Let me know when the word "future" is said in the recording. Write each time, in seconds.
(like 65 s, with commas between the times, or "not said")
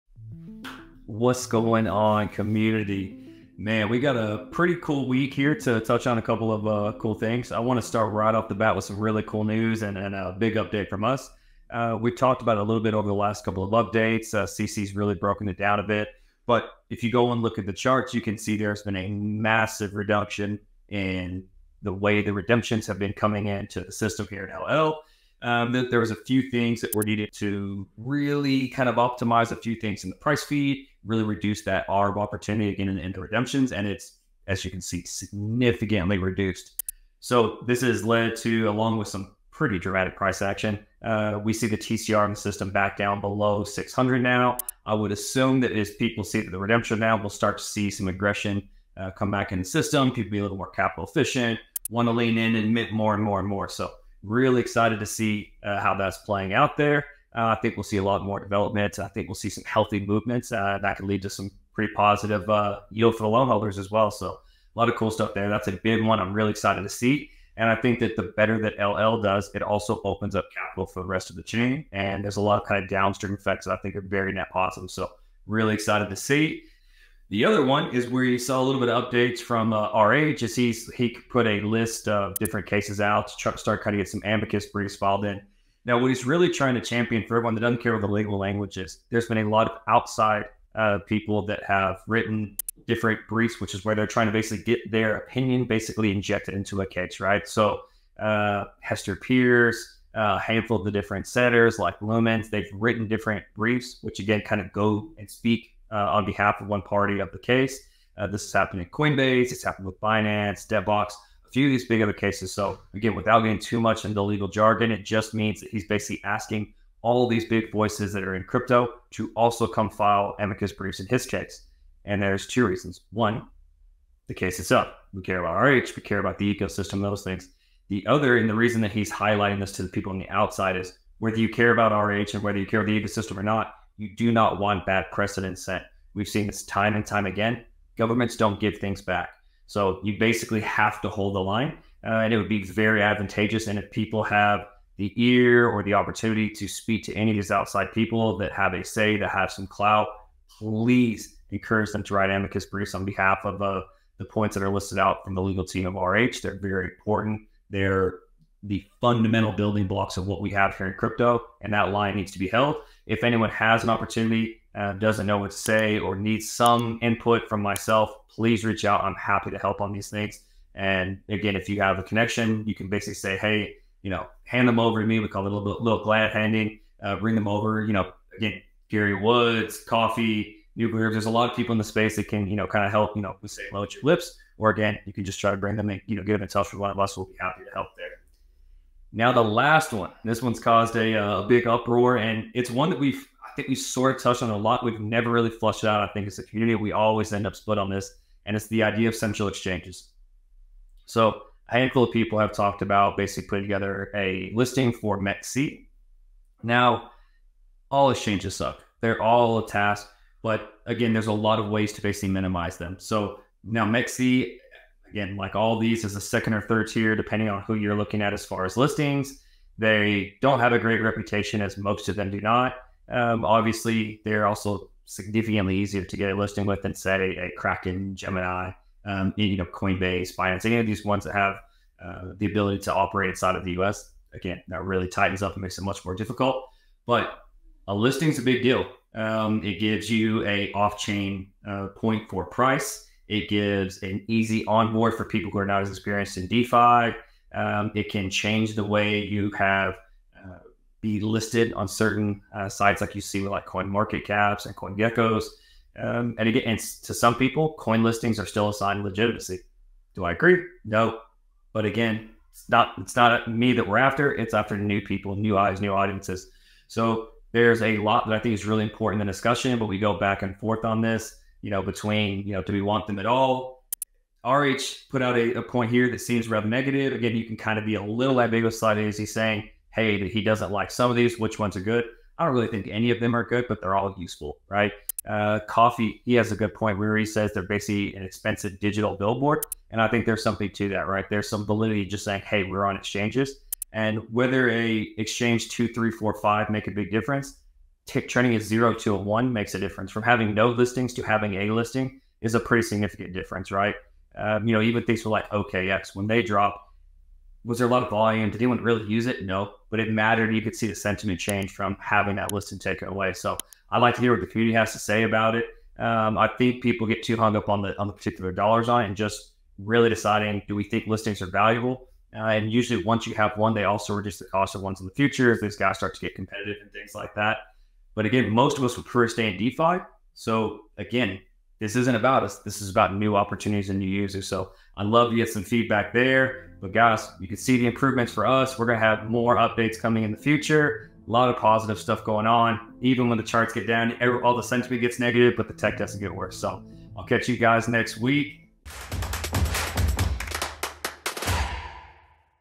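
325 s, 340 s.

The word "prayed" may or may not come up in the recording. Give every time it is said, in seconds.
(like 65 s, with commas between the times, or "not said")
not said.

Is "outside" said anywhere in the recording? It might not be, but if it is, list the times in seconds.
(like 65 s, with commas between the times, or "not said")
89 s, 130 s, 147 s.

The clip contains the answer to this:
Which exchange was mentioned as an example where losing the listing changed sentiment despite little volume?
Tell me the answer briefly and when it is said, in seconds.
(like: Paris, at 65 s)
OKX, at 305 s.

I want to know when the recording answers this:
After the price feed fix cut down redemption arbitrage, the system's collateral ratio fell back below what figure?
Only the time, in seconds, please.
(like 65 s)
43 s.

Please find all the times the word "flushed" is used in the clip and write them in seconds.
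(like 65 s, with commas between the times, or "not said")
195 s.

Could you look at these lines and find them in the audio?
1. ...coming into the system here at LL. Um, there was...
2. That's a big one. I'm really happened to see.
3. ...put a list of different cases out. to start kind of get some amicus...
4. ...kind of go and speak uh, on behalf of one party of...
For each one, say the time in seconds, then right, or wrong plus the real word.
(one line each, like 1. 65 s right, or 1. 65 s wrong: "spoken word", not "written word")
1. 23 s right
2. 65 s wrong: "excited", not "happened"
3. 81 s right
4. 104 s right.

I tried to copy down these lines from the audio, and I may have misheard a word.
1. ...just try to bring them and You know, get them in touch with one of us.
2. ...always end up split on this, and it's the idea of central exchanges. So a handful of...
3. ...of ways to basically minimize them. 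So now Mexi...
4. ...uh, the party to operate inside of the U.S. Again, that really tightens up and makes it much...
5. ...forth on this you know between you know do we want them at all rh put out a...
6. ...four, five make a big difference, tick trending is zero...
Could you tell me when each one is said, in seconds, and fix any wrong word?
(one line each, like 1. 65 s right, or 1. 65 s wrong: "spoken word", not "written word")
1. 185 s right
2. 196 s right
3. 211 s right
4. 232 s wrong: "ability", not "party"
5. 270 s right
6. 296 s right.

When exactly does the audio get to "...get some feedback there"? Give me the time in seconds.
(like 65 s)
335 s.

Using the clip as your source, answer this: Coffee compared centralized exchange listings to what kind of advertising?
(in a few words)
An expensive digital billboard.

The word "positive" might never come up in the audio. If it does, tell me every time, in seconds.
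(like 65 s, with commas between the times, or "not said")
61 s, 74 s, 341 s.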